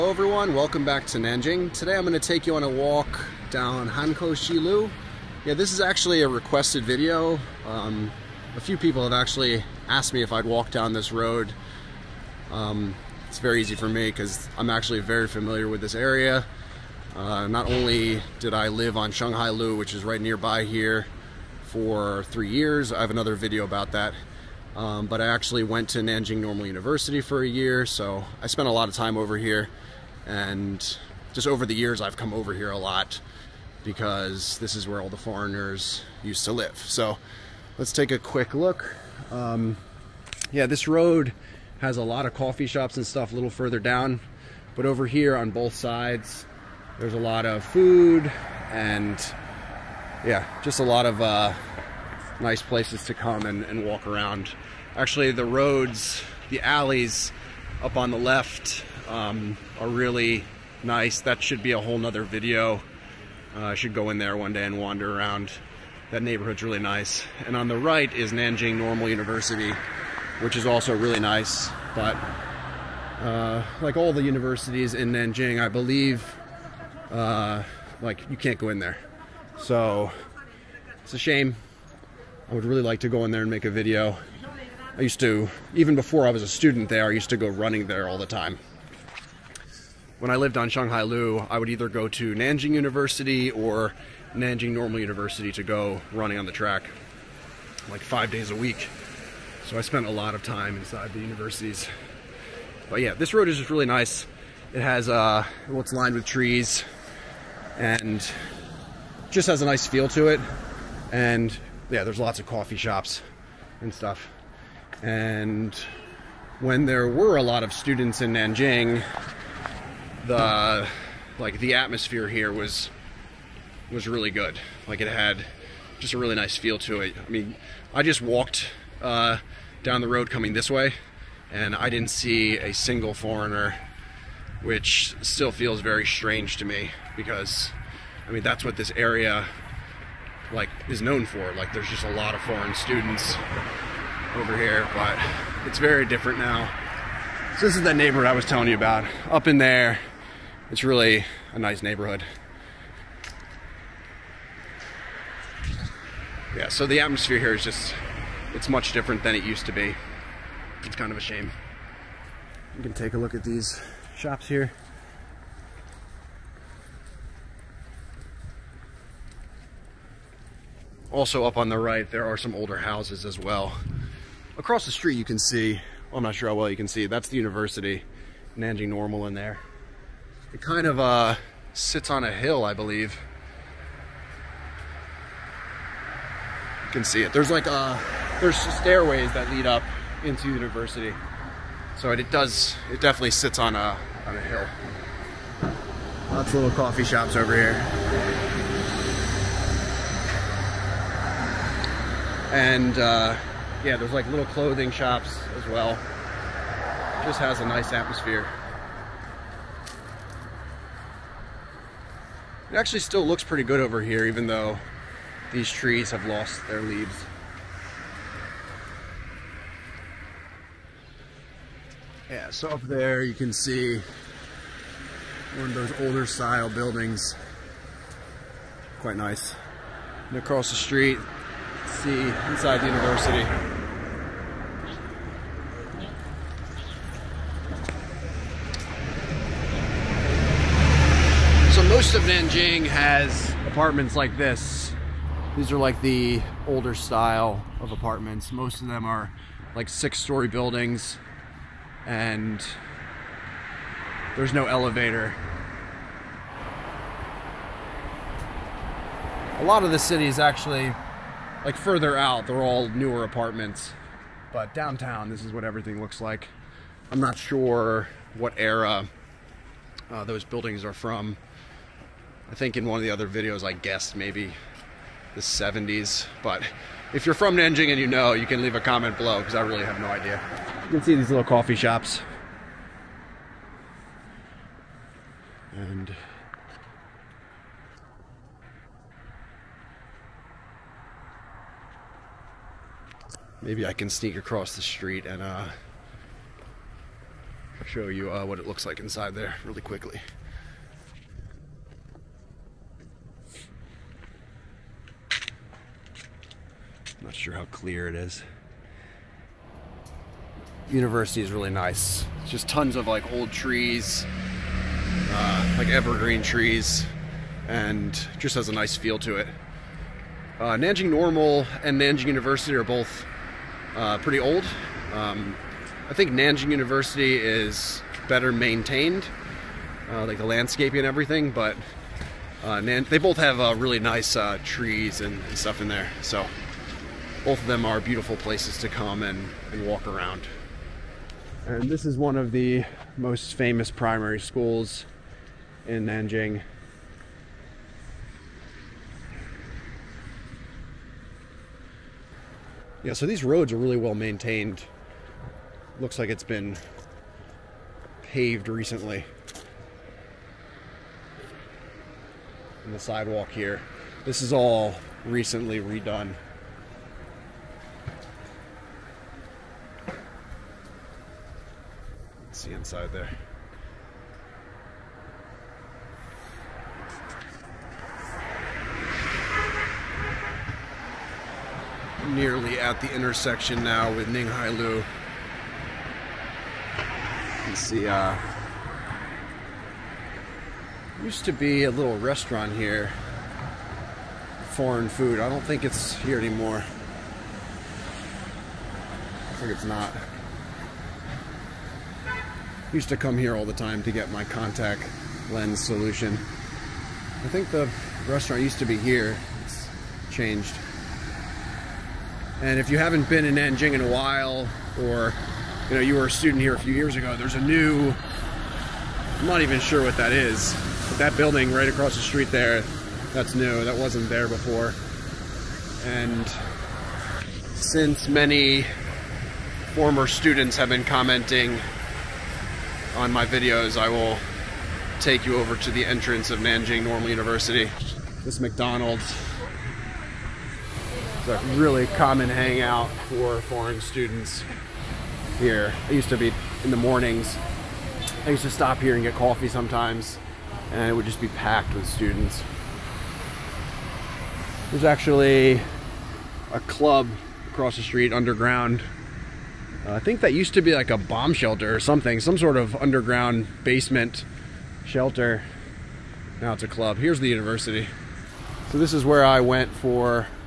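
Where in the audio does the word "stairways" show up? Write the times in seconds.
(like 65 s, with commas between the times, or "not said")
188 s.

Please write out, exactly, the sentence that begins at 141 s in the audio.
Like there's just a lot of foreign students over here, but it's very different now.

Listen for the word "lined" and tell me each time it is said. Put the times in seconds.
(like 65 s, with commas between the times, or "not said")
105 s.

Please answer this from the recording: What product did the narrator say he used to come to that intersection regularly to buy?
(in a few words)
Contact lens solution.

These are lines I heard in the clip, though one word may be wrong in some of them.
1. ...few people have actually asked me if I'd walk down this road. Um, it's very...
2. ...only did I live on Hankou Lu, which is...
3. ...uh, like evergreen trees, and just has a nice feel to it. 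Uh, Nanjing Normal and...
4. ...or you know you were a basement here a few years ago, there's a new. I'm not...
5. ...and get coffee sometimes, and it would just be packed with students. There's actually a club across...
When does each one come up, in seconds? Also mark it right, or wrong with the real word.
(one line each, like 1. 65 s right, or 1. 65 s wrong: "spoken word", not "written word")
1. 8 s right
2. 17 s wrong: "Shanghai", not "Hankou"
3. 315 s right
4. 414 s wrong: "student", not "basement"
5. 449 s right.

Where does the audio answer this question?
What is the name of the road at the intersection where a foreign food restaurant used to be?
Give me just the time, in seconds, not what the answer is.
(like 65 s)
384 s.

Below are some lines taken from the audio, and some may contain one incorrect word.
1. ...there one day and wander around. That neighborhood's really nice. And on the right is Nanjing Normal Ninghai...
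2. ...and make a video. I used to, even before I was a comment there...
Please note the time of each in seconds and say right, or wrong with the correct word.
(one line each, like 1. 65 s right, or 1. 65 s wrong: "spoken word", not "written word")
1. 64 s wrong: "University", not "Ninghai"
2. 83 s wrong: "student", not "comment".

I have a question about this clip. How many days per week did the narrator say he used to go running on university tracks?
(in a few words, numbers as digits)
5.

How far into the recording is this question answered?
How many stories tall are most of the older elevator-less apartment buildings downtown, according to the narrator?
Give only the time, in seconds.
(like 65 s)
249 s.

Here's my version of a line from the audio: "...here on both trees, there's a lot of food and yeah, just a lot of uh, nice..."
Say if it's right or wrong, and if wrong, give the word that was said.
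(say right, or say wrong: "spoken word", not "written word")
wrong: "sides", not "trees".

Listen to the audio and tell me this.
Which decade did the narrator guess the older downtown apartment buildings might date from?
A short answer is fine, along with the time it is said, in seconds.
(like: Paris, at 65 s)
The 70s, at 275 s.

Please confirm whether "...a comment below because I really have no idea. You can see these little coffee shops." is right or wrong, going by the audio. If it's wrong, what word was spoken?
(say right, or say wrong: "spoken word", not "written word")
right.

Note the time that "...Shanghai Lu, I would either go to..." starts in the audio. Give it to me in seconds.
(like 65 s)
90 s.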